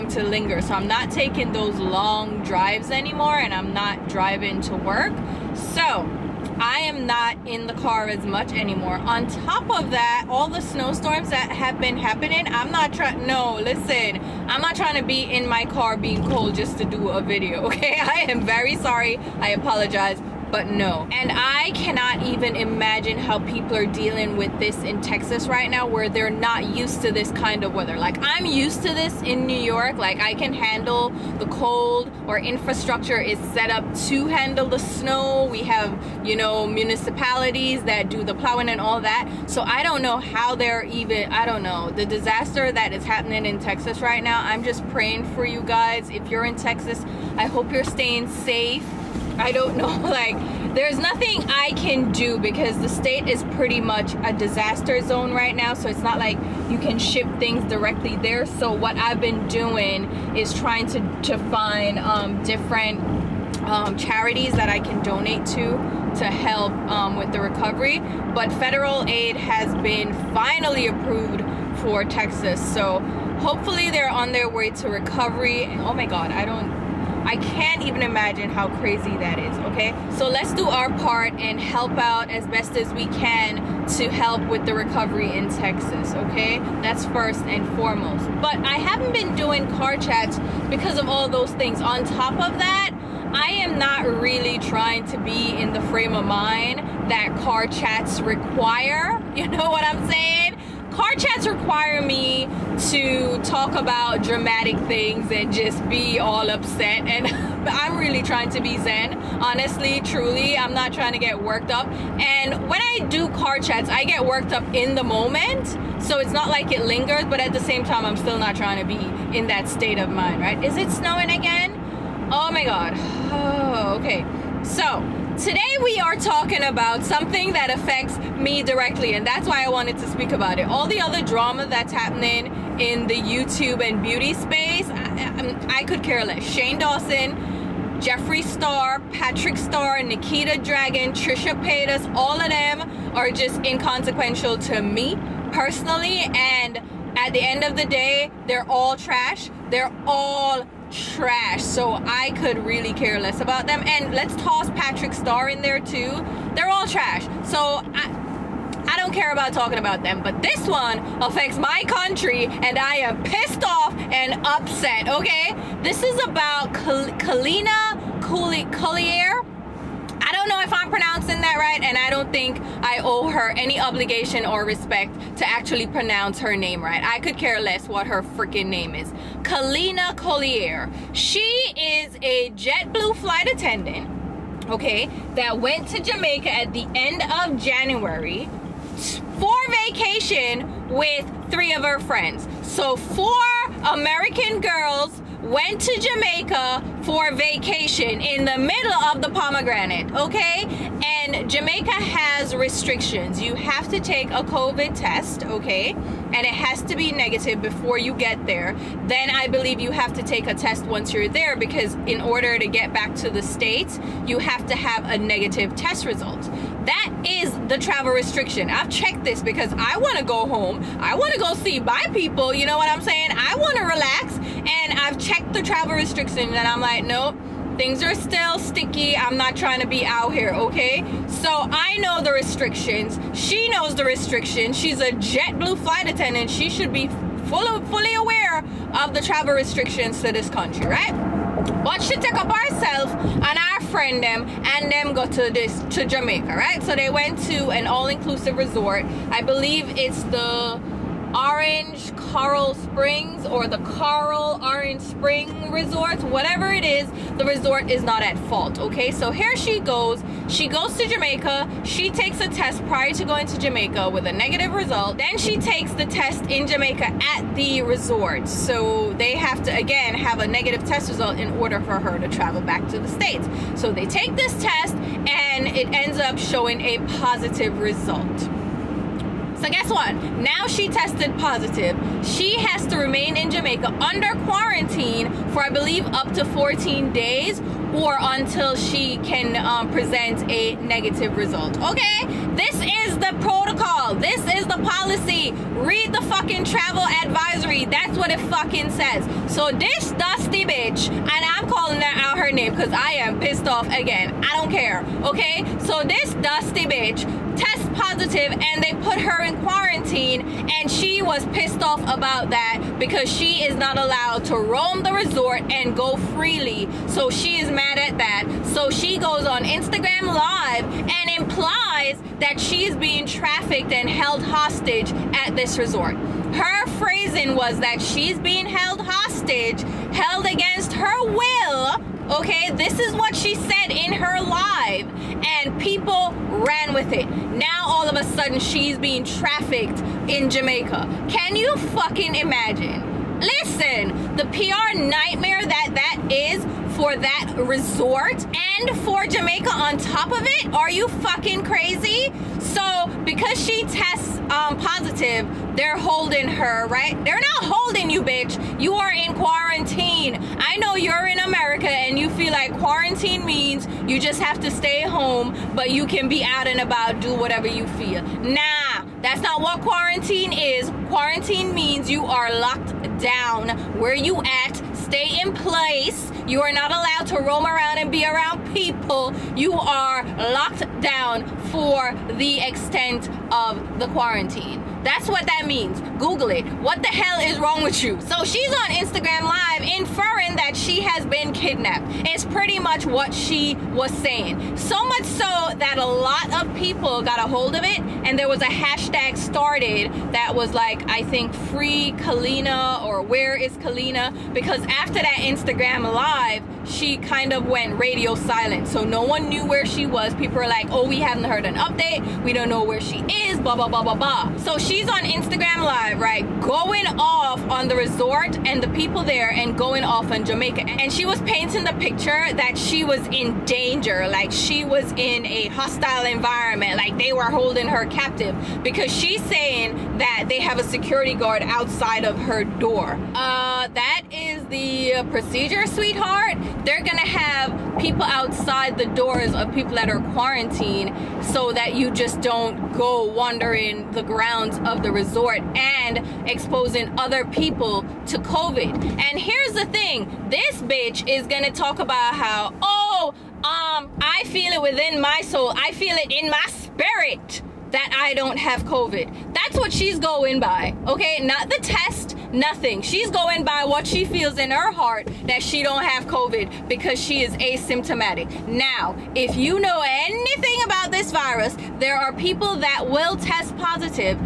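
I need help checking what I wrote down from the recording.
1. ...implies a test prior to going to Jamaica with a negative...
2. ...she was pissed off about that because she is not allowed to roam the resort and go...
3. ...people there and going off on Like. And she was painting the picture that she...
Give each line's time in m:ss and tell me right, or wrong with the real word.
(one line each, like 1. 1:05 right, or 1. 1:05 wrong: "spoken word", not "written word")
1. 4:22 wrong: "takes", not "implies"
2. 5:10 right
3. 6:58 wrong: "Jamaica", not "Like".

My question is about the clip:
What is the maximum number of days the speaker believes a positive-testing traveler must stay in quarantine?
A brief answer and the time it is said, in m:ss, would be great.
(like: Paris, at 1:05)
14, at 4:46.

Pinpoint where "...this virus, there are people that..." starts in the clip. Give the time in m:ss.
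7:51.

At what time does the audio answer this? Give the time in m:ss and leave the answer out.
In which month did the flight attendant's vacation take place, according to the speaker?
3:07.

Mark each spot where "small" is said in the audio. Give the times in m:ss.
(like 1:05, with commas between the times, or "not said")
not said.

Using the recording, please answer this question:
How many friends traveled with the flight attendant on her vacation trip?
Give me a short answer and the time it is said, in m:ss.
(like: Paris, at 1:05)
3, at 3:11.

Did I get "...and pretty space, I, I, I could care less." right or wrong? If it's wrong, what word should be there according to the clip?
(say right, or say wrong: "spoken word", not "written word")
wrong: "beauty", not "pretty".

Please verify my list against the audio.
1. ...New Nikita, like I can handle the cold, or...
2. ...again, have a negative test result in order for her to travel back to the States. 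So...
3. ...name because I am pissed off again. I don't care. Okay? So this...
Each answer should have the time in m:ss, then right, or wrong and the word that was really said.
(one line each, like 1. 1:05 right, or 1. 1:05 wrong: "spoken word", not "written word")
1. 0:29 wrong: "York", not "Nikita"
2. 4:29 right
3. 5:02 right.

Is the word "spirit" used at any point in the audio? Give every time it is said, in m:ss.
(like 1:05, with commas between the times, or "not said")
7:36.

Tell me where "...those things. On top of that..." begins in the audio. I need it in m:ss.
1:31.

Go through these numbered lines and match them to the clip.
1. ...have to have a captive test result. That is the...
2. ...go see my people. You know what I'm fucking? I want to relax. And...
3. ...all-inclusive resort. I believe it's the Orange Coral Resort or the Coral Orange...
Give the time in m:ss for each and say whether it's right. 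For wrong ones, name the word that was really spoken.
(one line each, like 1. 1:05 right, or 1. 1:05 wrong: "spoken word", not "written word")
1. 3:34 wrong: "negative", not "captive"
2. 3:41 wrong: "saying", not "fucking"
3. 4:07 wrong: "Springs", not "Resort".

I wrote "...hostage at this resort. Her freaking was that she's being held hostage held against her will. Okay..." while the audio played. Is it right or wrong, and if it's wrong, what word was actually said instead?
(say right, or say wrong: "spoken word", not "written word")
wrong: "phrasing", not "freaking".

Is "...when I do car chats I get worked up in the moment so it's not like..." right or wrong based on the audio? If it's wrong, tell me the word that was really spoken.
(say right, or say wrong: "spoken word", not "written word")
right.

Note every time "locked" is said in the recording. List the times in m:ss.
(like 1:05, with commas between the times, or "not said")
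6:12, 6:20.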